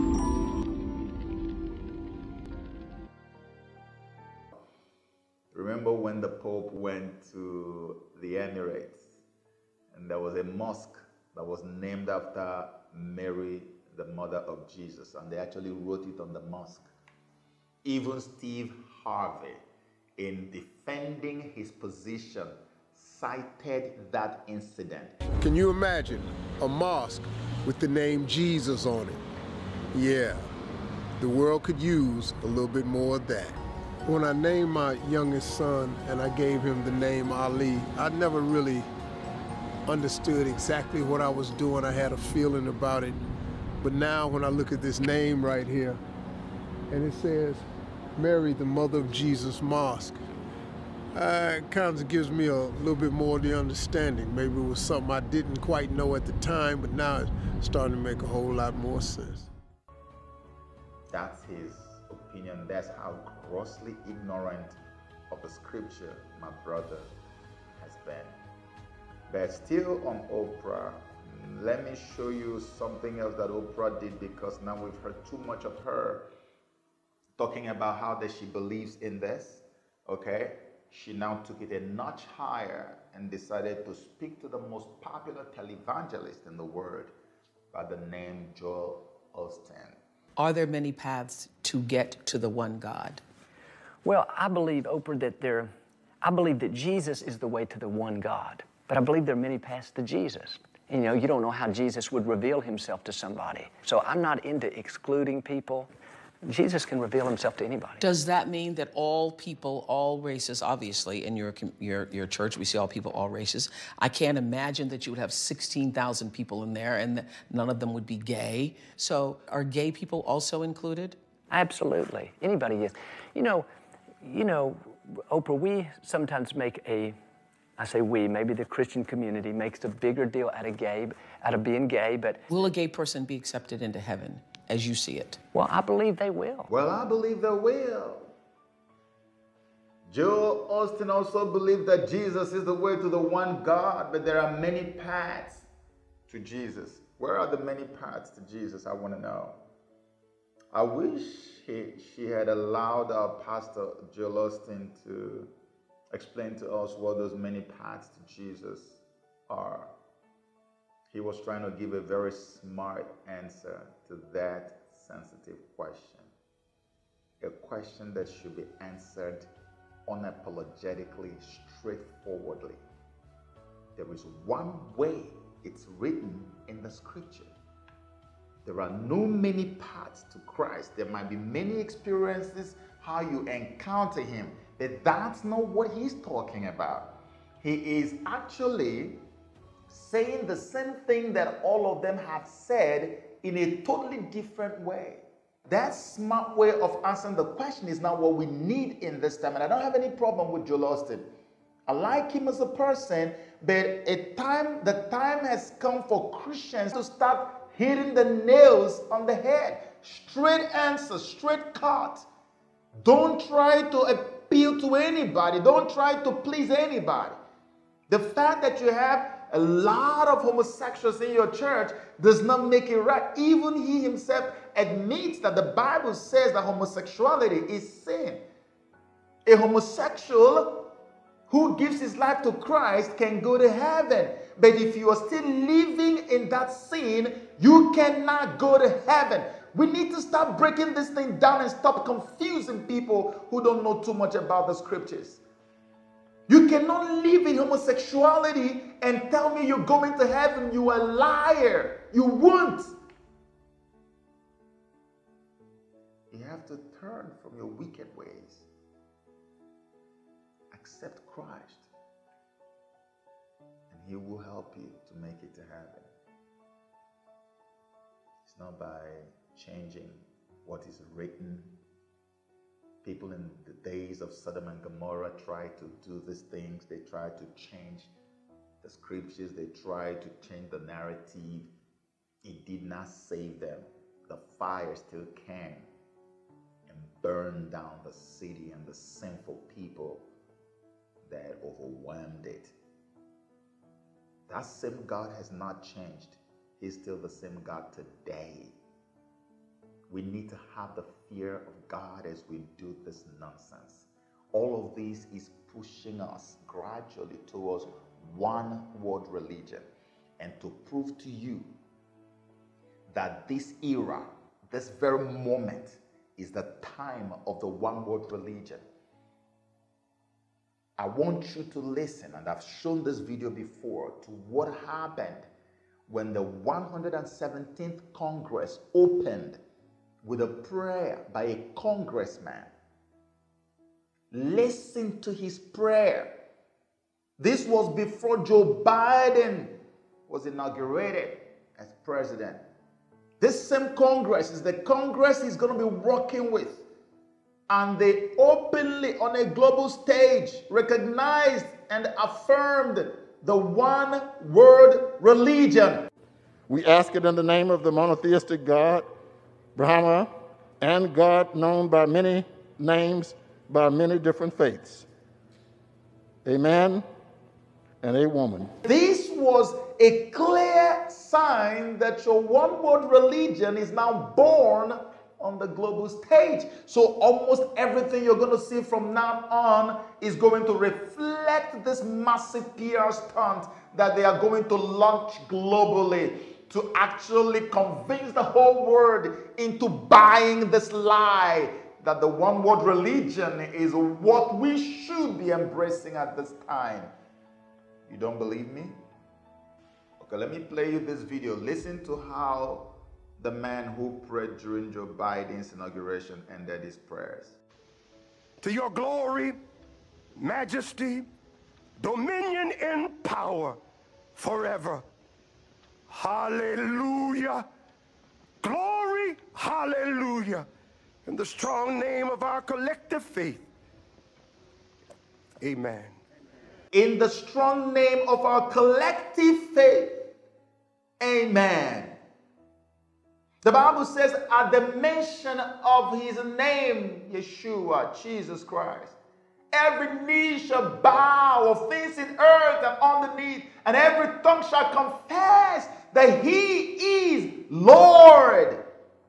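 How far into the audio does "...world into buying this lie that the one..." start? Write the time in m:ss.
6:28.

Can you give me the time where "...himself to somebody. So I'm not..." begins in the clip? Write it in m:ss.
1:42.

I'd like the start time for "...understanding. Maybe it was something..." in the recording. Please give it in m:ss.
0:53.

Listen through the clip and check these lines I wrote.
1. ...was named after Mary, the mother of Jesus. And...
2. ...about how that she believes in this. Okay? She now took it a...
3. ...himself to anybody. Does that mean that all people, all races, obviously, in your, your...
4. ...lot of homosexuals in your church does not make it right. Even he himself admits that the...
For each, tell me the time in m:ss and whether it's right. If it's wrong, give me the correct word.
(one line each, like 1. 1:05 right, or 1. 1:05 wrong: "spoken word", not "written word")
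1. 0:11 right
2. 1:17 right
3. 1:47 right
4. 3:39 right.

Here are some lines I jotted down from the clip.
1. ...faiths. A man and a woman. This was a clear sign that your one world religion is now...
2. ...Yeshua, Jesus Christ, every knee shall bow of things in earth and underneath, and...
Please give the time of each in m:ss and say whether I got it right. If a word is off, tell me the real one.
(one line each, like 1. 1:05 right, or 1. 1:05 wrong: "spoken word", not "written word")
1. 6:04 right
2. 7:17 right.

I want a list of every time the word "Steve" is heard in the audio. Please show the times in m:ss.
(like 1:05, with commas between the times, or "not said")
0:18.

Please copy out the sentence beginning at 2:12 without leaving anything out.
Will a gay person be accepted into heaven as you see it?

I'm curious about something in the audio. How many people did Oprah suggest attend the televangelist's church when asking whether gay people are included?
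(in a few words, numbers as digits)
16,000.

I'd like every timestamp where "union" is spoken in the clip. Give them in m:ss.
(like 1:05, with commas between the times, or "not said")
not said.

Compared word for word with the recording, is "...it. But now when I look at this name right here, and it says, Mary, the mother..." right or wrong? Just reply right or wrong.
right.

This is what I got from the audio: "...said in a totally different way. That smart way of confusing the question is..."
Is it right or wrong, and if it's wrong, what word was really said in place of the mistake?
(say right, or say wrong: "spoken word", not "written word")
wrong: "answering", not "confusing".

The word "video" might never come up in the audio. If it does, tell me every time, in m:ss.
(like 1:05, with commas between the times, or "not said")
5:23, 6:41.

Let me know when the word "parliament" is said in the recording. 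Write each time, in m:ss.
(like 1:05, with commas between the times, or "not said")
not said.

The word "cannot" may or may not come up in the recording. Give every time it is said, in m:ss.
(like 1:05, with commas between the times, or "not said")
3:57, 4:06.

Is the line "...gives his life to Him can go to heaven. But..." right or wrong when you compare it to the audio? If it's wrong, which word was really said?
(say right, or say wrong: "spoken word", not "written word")
wrong: "Christ", not "Him".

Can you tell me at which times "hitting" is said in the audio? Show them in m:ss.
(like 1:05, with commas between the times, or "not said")
3:27.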